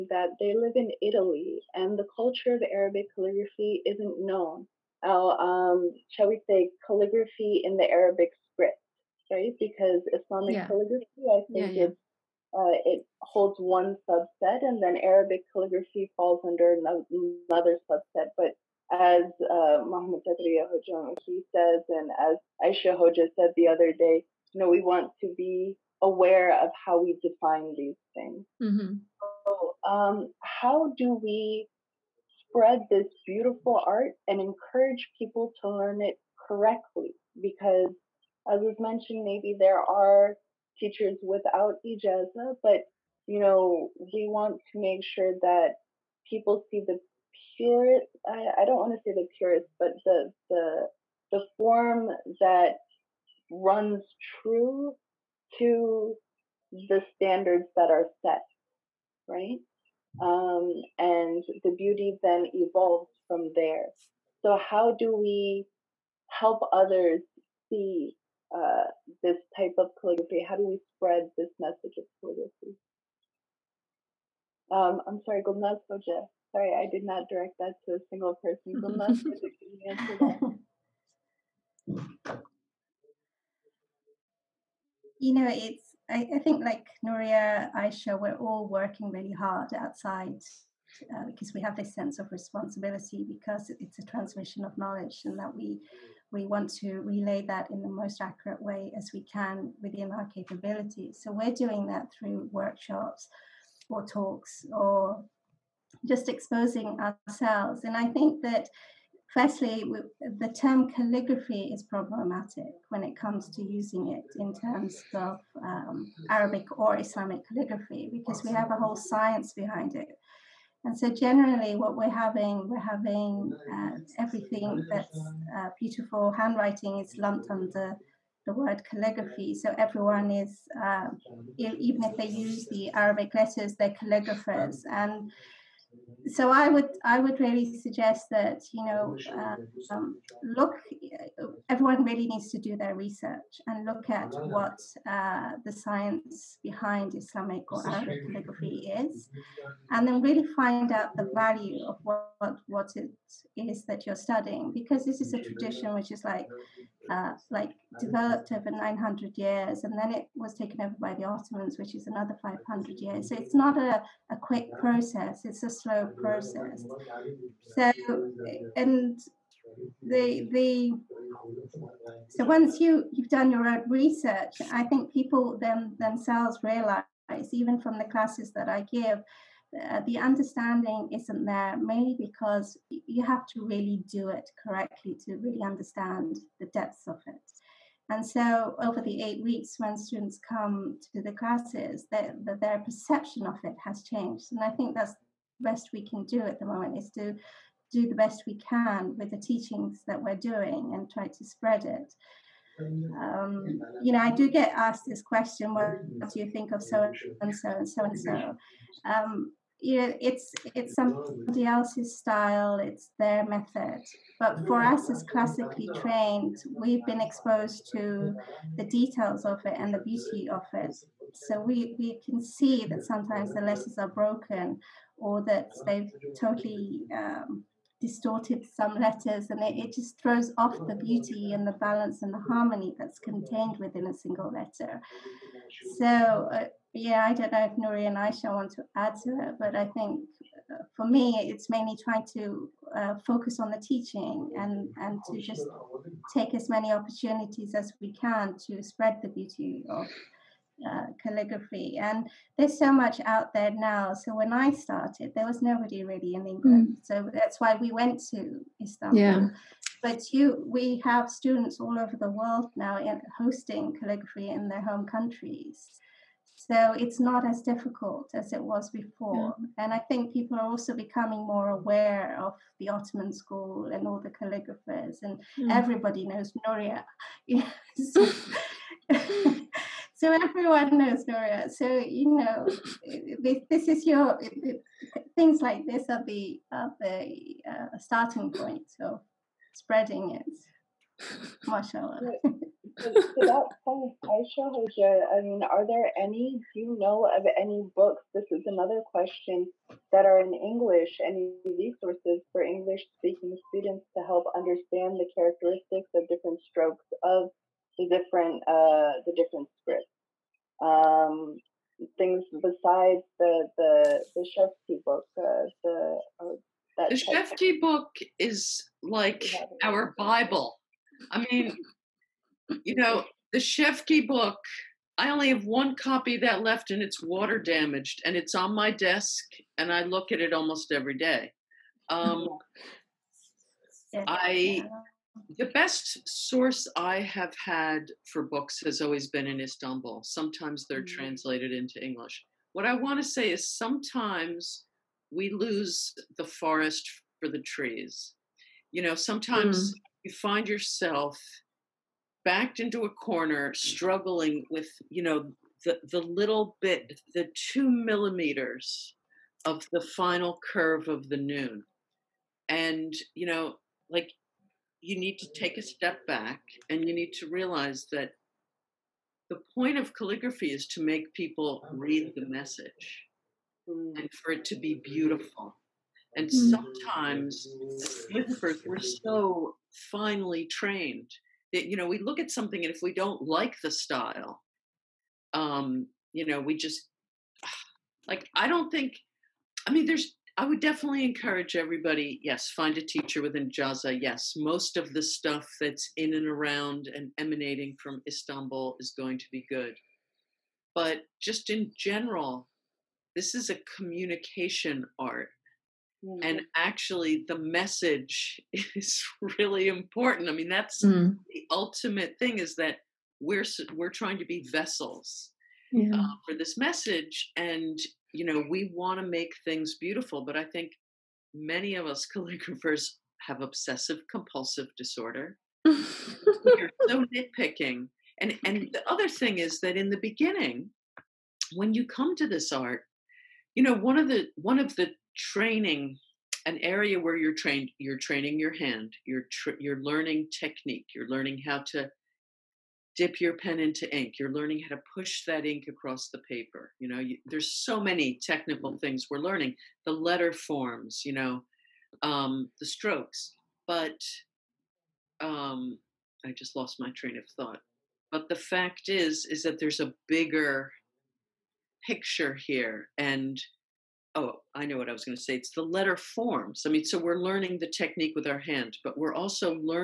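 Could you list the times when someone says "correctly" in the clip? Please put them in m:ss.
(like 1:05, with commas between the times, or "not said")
0:36, 3:04.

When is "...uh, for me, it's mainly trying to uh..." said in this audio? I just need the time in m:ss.
4:00.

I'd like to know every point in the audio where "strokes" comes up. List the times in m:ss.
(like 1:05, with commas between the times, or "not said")
5:06, 7:32.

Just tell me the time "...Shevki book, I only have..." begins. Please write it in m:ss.
5:23.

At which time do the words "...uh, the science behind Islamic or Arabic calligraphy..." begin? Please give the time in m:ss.
2:25.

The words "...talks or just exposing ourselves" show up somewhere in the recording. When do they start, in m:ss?
1:44.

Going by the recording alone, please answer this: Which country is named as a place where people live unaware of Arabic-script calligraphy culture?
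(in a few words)
Italy.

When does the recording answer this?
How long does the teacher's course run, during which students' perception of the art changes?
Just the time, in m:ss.
3:09.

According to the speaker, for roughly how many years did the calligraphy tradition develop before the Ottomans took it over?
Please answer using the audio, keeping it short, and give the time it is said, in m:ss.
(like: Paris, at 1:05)
900 years, at 2:38.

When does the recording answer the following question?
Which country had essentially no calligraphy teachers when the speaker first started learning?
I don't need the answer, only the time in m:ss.
4:16.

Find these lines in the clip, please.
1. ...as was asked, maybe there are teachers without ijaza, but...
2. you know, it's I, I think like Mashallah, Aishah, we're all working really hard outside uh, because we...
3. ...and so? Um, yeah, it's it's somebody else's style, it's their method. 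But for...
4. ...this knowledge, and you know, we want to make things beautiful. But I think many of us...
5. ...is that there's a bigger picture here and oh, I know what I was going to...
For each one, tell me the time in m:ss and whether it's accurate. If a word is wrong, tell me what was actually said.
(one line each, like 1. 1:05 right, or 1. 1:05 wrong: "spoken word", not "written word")
1. 0:38 wrong: "mentioned", not "asked"
2. 1:25 wrong: "Nuria", not "Mashallah"
3. 3:28 right
4. 6:56 wrong: "message", not "knowledge"
5. 7:39 right.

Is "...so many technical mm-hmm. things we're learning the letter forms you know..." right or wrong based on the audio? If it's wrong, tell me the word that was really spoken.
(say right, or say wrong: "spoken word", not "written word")
right.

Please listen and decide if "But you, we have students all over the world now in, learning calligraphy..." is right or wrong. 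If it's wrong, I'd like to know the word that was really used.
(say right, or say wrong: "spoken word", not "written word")
wrong: "hosting", not "learning".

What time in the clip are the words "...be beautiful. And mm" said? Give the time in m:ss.
6:14.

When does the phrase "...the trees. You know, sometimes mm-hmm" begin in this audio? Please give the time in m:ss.
5:47.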